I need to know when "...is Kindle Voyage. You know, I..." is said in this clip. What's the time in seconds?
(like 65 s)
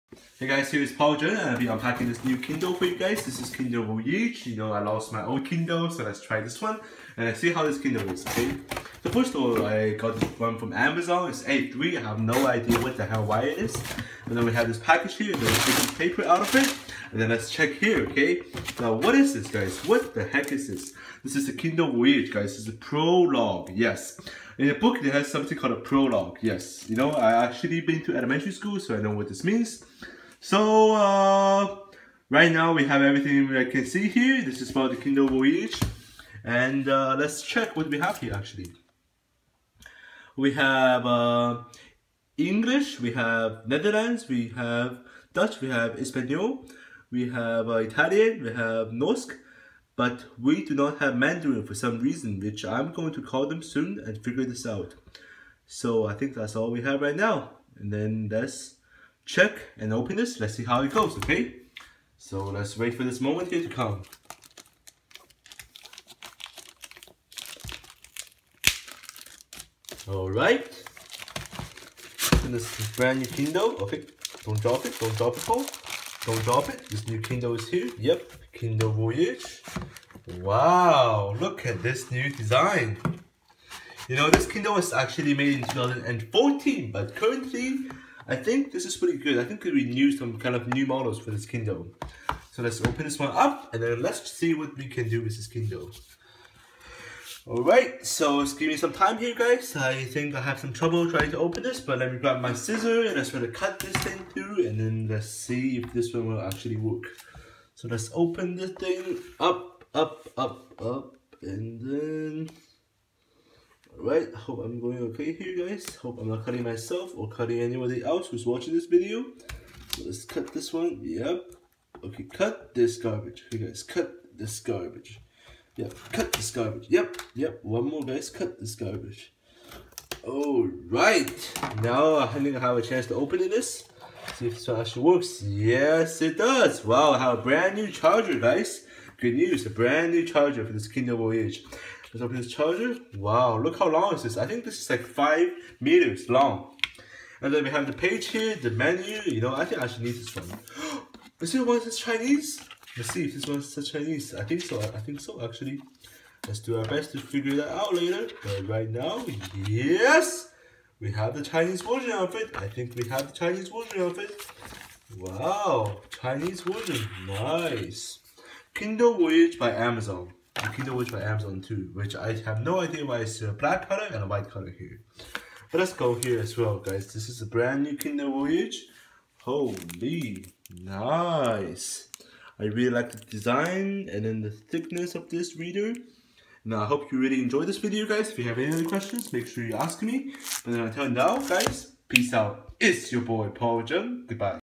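3 s.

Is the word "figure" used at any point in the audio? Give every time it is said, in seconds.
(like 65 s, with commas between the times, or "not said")
54 s, 157 s.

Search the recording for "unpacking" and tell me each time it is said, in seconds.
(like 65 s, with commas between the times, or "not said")
1 s.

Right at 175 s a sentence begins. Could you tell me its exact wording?
But let's go here as well, guys.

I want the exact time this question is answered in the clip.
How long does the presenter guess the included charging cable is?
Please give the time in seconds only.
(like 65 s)
145 s.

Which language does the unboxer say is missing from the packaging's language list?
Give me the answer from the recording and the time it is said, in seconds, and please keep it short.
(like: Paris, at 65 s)
Mandarin, at 51 s.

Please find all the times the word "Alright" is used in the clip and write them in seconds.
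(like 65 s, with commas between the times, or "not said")
70 s, 97 s, 130 s.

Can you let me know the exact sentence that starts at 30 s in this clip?
So uh, right now we have everything I can see here.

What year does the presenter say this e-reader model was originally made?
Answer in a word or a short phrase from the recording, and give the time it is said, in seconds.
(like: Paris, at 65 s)
2014, at 85 s.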